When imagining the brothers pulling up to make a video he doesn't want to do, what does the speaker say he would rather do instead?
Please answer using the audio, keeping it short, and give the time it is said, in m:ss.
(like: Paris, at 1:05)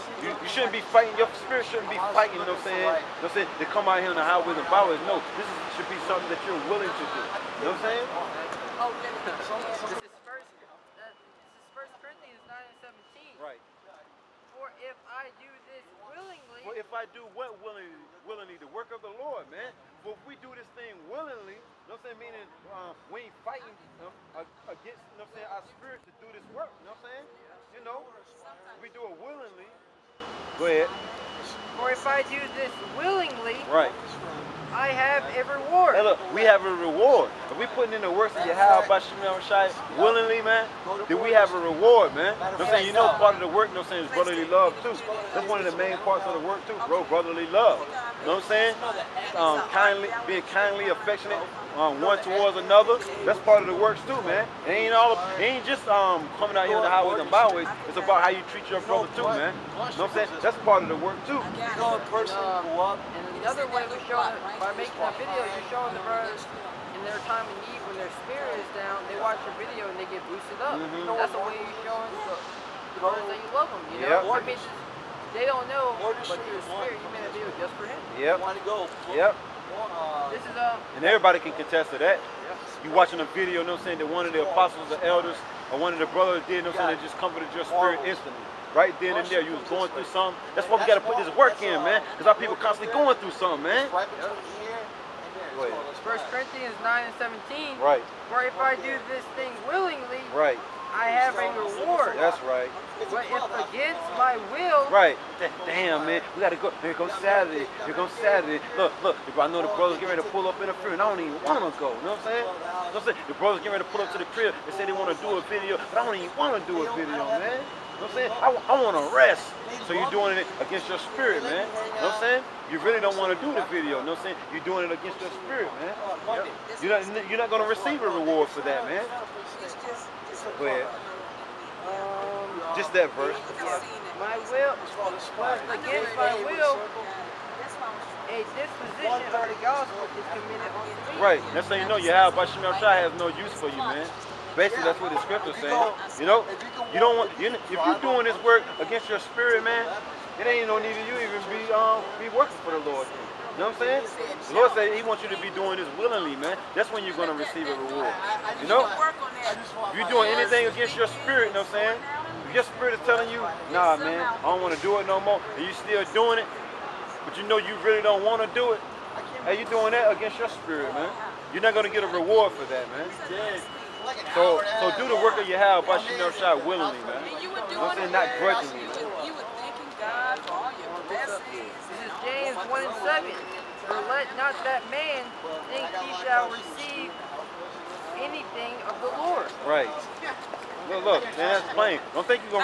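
rest, at 1:59.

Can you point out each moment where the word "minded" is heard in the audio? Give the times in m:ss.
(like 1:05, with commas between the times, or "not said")
not said.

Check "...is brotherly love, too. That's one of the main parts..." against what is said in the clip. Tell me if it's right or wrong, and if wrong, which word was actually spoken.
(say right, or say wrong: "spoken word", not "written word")
right.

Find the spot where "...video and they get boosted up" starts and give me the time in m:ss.
1:09.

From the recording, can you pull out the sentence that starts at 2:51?
You're not gonna get a reward for that, man.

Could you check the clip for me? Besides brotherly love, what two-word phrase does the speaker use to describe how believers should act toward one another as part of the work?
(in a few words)
kindly affectionate.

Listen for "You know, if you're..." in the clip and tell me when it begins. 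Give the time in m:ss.
2:38.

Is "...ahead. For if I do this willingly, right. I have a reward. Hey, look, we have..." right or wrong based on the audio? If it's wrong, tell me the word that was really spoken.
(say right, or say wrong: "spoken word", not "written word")
right.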